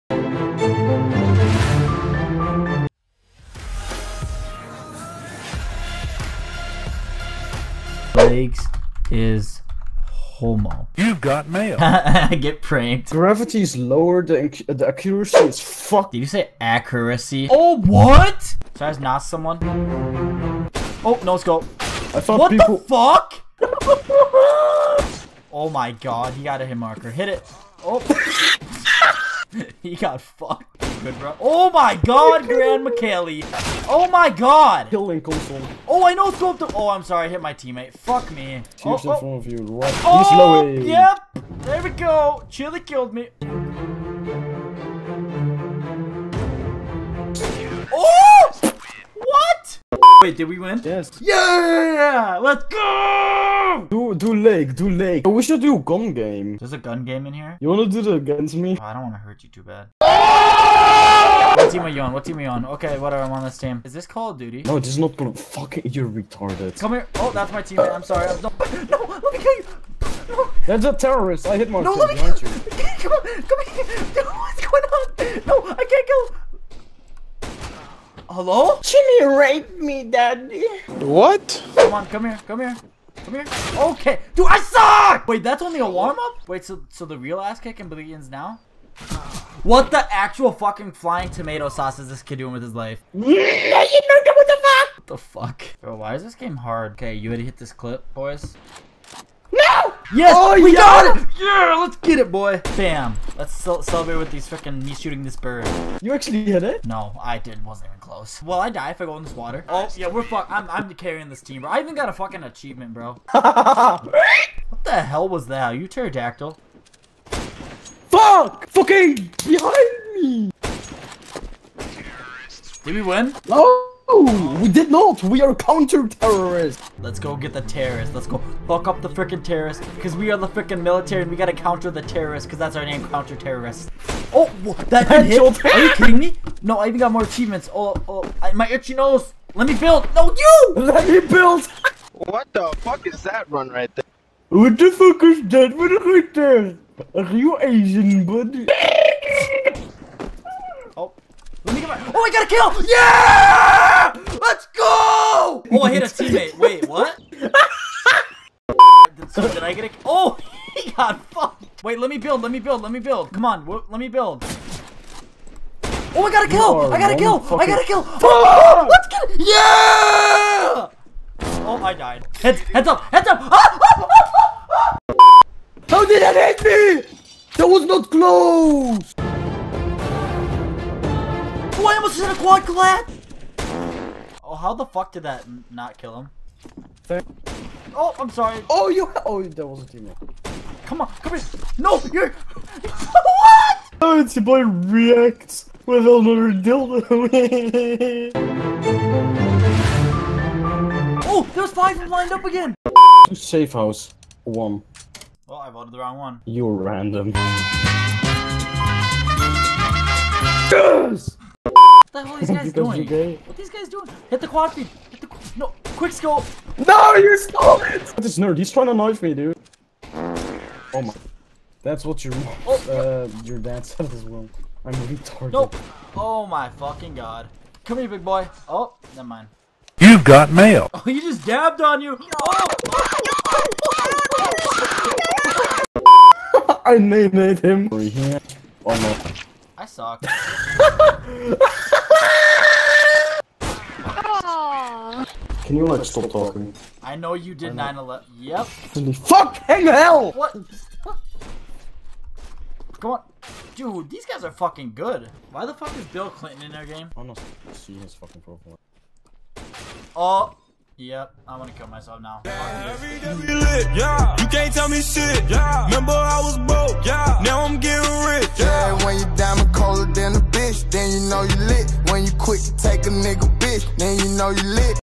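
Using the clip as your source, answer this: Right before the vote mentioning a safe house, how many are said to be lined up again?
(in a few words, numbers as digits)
5.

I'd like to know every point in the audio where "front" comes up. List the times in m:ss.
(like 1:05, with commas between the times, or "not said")
0:39.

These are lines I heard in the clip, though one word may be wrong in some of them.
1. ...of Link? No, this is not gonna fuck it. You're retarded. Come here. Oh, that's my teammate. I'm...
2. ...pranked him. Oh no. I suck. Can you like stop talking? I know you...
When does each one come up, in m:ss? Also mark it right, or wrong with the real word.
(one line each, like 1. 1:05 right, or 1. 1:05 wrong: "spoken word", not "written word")
1. 1:04 wrong: "Duty", not "Link"
2. 3:56 wrong: "named", not "pranked".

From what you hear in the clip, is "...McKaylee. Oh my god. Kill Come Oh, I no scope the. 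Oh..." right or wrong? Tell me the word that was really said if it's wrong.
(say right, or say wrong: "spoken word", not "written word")
wrong: "Link", not "Come".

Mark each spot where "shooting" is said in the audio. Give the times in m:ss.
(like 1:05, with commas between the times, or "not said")
1:44.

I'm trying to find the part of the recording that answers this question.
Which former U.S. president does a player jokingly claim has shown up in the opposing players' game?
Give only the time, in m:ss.
4:16.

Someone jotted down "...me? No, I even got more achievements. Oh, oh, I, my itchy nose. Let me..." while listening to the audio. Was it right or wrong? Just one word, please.
right.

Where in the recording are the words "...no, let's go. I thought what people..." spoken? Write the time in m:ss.
0:21.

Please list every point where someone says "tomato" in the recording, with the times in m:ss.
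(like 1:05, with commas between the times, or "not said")
1:31.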